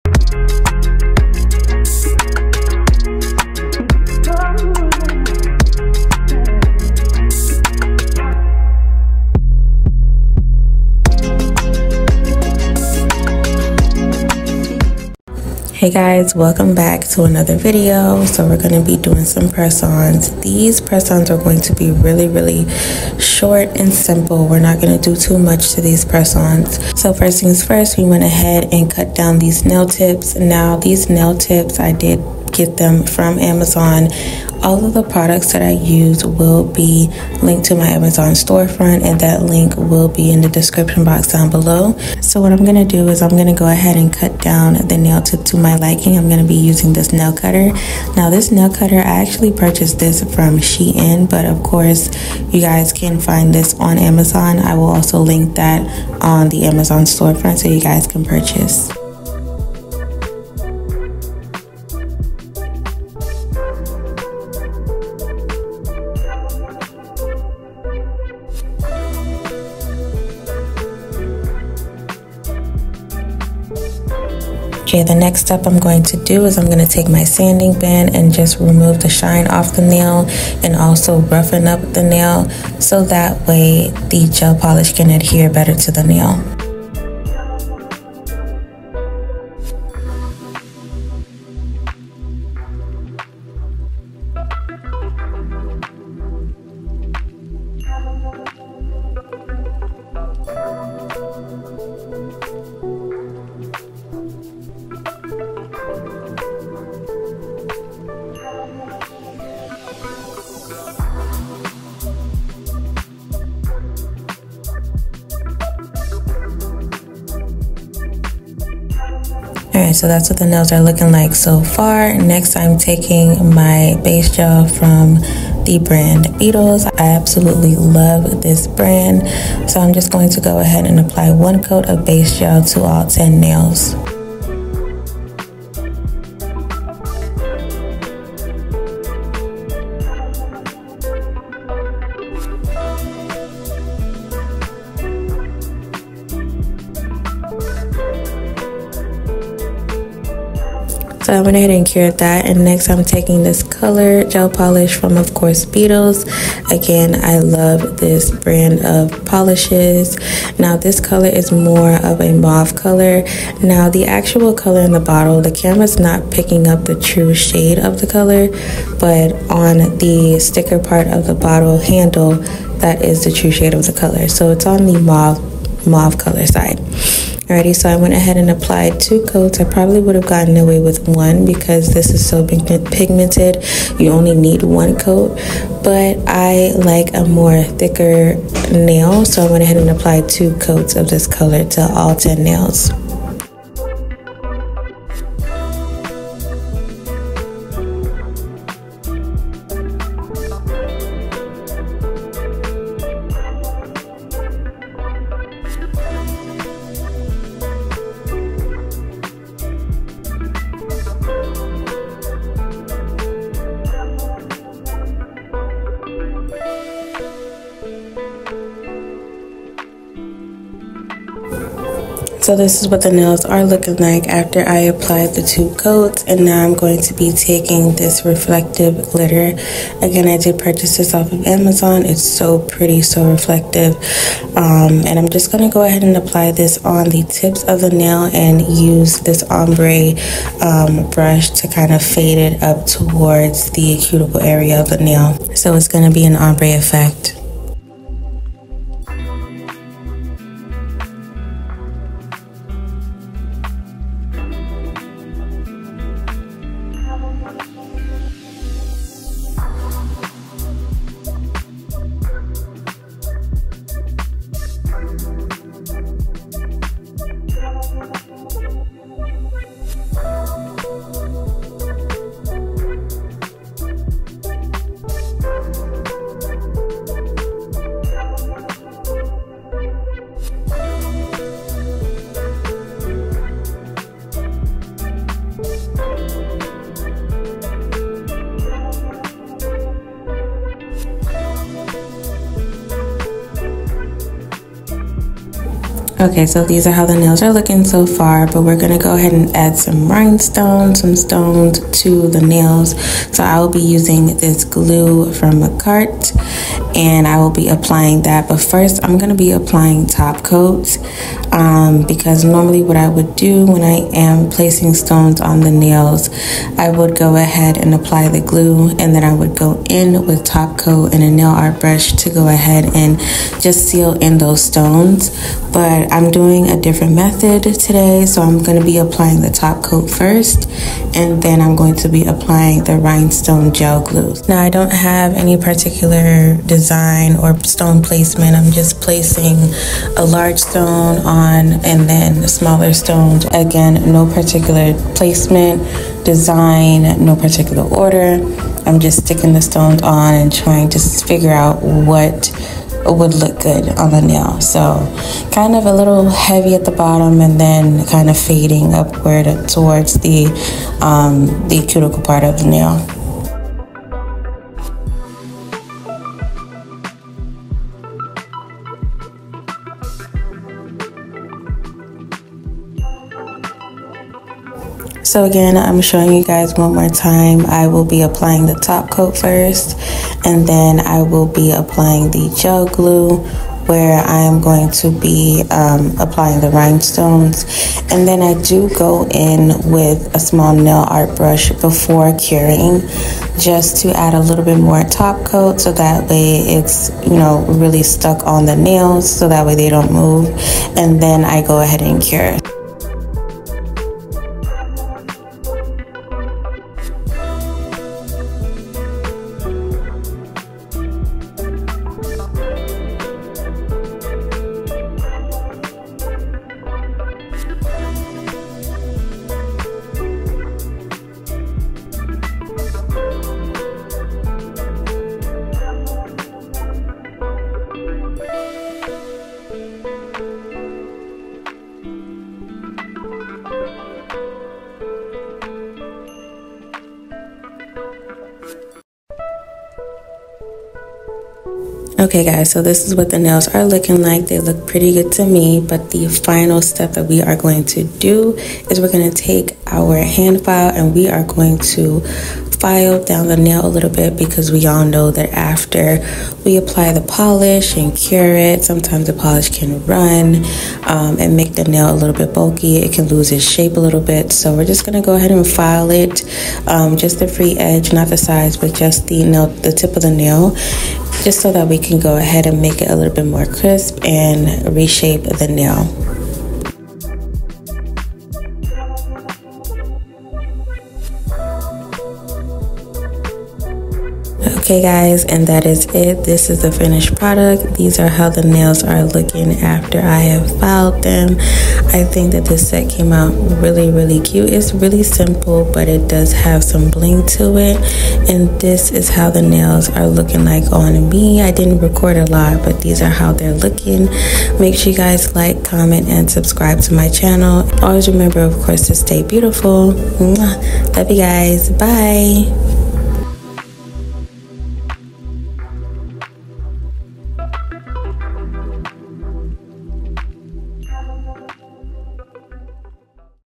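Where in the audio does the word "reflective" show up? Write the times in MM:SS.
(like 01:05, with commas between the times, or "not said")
03:48, 03:53.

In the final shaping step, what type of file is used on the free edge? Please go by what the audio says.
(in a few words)
hand file.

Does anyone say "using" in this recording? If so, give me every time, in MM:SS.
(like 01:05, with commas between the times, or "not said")
00:46, 05:03.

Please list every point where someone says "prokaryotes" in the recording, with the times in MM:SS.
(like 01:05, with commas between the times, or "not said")
not said.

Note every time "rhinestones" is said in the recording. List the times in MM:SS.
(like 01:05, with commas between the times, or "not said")
05:00, 05:32, 06:26.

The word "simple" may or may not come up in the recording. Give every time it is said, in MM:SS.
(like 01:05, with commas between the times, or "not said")
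00:23, 08:15.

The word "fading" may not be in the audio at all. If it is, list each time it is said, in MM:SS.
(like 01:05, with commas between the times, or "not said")
05:58.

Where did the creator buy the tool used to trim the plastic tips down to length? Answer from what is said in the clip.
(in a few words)
Shein.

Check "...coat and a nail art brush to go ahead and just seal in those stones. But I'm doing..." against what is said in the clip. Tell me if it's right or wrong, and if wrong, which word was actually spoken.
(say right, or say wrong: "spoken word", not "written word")
right.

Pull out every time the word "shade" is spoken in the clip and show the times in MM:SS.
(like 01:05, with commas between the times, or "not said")
02:47, 02:53.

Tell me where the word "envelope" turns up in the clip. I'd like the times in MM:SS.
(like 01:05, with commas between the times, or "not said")
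not said.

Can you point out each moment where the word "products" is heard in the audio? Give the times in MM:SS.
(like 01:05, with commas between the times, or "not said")
00:35, 08:07.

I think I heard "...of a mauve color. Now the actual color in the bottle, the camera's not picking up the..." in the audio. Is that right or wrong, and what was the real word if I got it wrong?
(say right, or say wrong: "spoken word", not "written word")
right.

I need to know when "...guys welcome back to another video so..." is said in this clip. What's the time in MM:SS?
00:15.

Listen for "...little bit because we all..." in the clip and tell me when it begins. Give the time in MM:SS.
07:33.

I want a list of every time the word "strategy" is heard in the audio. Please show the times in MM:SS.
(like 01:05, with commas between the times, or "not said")
not said.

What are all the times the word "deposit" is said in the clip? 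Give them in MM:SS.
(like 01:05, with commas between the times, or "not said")
not said.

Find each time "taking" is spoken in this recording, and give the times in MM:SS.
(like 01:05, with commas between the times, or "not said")
02:02, 02:33, 03:47.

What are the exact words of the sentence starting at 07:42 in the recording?
It can lose its shape a little bit.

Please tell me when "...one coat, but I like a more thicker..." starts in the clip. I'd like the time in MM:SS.
03:04.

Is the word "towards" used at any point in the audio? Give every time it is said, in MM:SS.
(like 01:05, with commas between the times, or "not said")
04:02, 05:59.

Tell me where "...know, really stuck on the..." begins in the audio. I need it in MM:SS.
06:37.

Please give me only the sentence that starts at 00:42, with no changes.
So, what I'm gonna do is, I'm gonna go ahead and cut down the nail tip to my liking.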